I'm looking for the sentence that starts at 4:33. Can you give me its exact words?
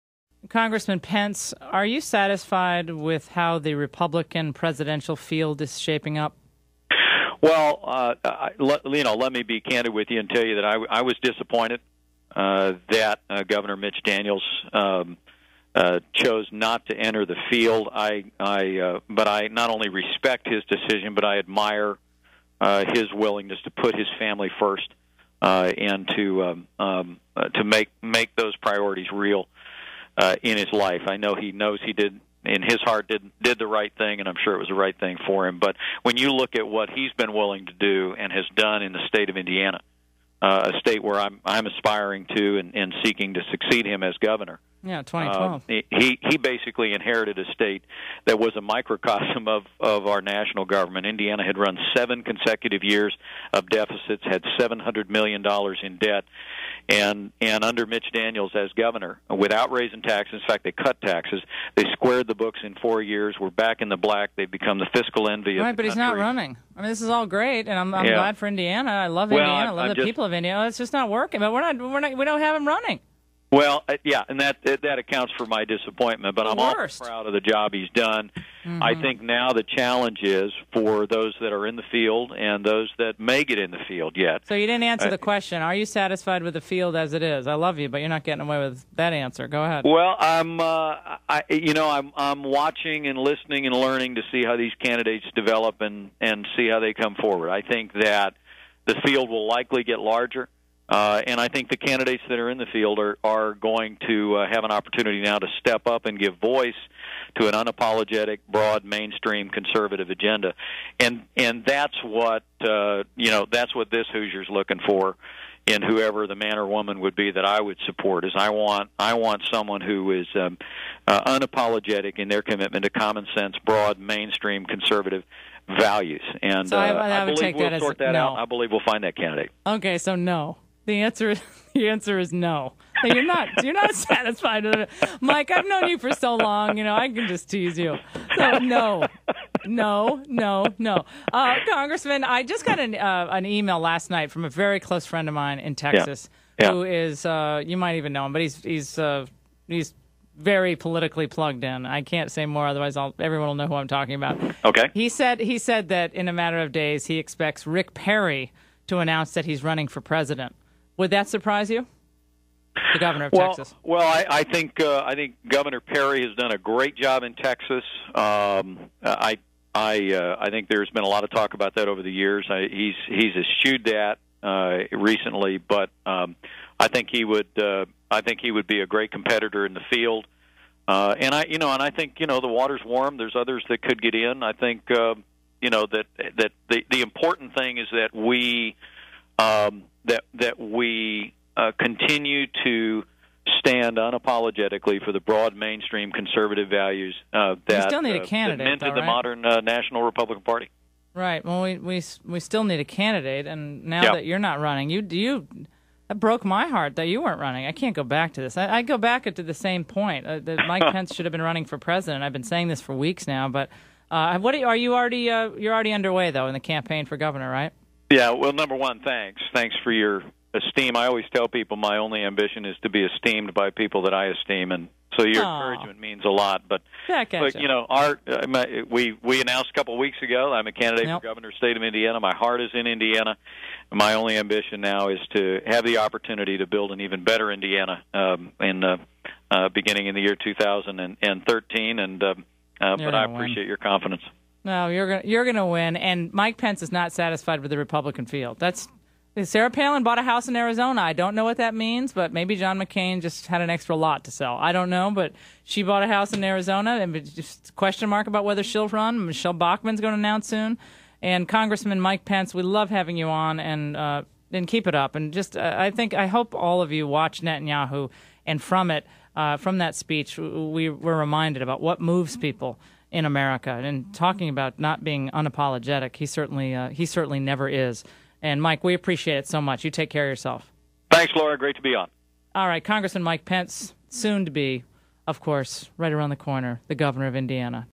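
And talking about not being unapologetic, he certainly uh, he certainly never is.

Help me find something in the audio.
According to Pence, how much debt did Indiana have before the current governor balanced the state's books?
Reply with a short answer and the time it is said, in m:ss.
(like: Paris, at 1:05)
$700 million, at 0:54.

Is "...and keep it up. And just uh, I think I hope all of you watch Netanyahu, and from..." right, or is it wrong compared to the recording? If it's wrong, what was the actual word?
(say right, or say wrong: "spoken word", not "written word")
right.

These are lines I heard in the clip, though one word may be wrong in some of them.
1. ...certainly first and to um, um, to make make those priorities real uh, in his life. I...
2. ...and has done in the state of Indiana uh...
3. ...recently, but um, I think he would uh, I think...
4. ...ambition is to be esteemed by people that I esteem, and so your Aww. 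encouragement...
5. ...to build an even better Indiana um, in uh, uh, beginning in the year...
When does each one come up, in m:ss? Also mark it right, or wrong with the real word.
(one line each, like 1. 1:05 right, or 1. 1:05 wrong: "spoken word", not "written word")
1. 0:24 wrong: "family", not "certainly"
2. 0:38 right
3. 2:54 right
4. 3:42 right
5. 3:56 right.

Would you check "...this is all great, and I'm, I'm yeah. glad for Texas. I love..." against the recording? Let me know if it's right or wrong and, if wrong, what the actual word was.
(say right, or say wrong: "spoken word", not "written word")
wrong: "Indiana", not "Texas".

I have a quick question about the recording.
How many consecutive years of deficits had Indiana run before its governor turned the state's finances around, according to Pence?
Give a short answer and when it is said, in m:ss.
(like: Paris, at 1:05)
7, at 0:51.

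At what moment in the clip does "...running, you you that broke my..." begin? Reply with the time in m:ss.
3:24.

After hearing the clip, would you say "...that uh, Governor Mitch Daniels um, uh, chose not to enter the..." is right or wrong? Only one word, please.
right.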